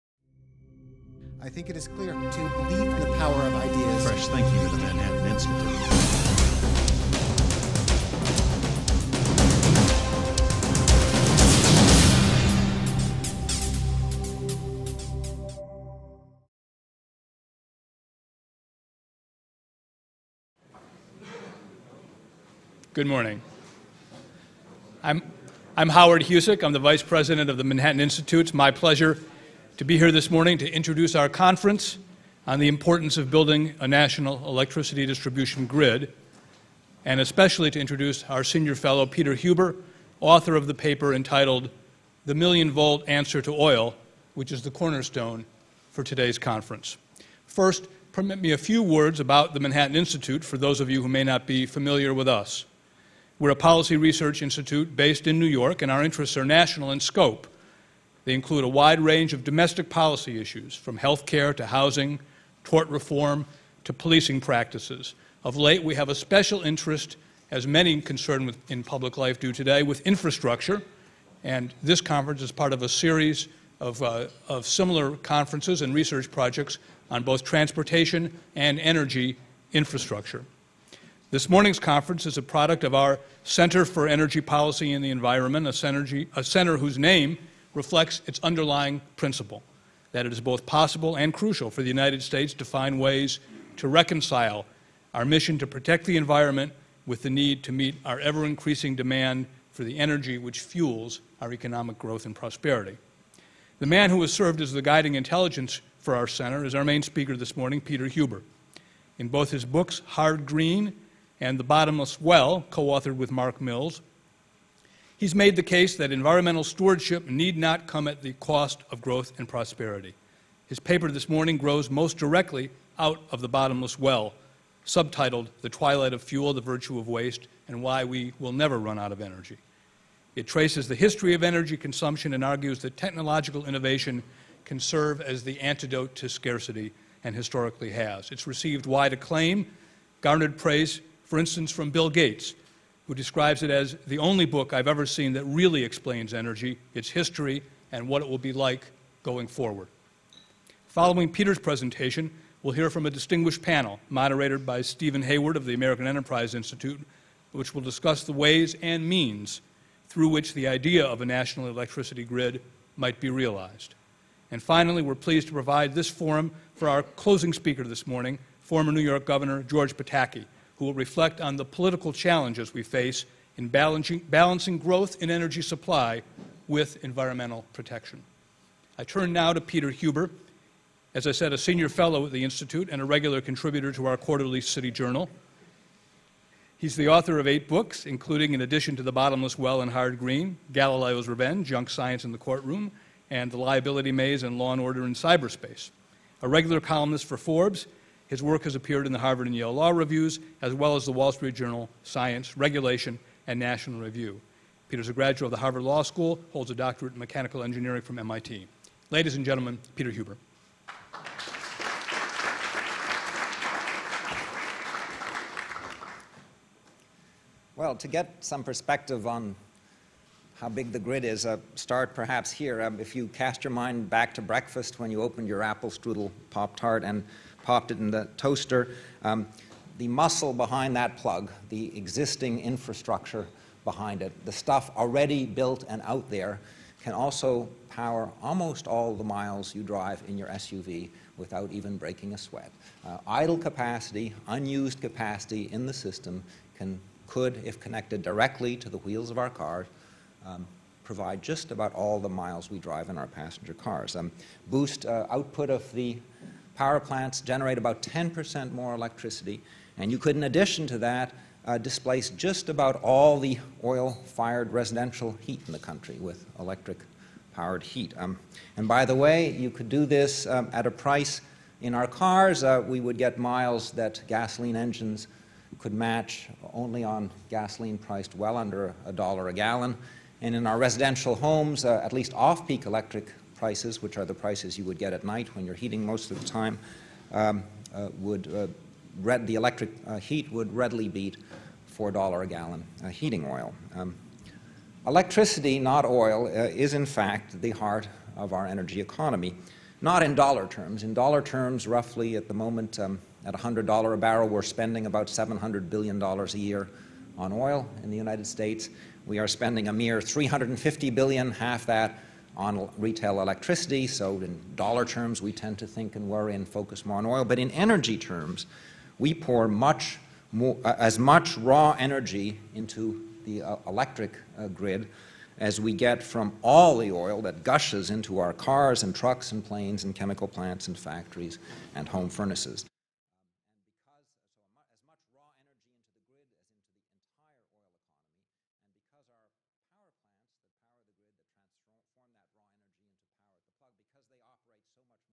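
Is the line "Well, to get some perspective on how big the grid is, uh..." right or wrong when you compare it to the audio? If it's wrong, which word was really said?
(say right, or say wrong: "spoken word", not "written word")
right.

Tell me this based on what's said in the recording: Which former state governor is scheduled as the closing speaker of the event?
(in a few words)
George Pataki.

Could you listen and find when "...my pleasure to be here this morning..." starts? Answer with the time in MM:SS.
00:28.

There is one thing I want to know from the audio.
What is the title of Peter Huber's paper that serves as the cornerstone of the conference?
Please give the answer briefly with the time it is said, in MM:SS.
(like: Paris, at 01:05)
The Million Volt Answer to Oil, at 00:42.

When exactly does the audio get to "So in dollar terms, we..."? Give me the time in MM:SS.
05:14.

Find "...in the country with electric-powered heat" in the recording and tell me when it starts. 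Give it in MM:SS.
04:25.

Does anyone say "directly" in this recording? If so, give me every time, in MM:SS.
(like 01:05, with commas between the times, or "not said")
02:02, 04:08.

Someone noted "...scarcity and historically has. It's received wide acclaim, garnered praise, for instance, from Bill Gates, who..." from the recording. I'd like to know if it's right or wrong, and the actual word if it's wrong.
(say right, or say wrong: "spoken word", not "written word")
right.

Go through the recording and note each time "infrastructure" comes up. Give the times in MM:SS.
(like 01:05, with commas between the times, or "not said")
01:10, 01:19, 03:52.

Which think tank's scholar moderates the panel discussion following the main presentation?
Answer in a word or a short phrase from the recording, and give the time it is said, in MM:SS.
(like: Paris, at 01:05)
American Enterprise Institute, at 02:35.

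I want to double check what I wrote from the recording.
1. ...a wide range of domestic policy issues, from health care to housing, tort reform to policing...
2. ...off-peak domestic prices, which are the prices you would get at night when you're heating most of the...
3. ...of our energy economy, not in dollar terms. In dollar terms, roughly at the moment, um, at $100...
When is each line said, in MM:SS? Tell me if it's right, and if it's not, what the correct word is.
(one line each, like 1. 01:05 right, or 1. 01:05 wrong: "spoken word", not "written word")
1. 00:58 right
2. 04:42 wrong: "electric", not "domestic"
3. 04:58 right.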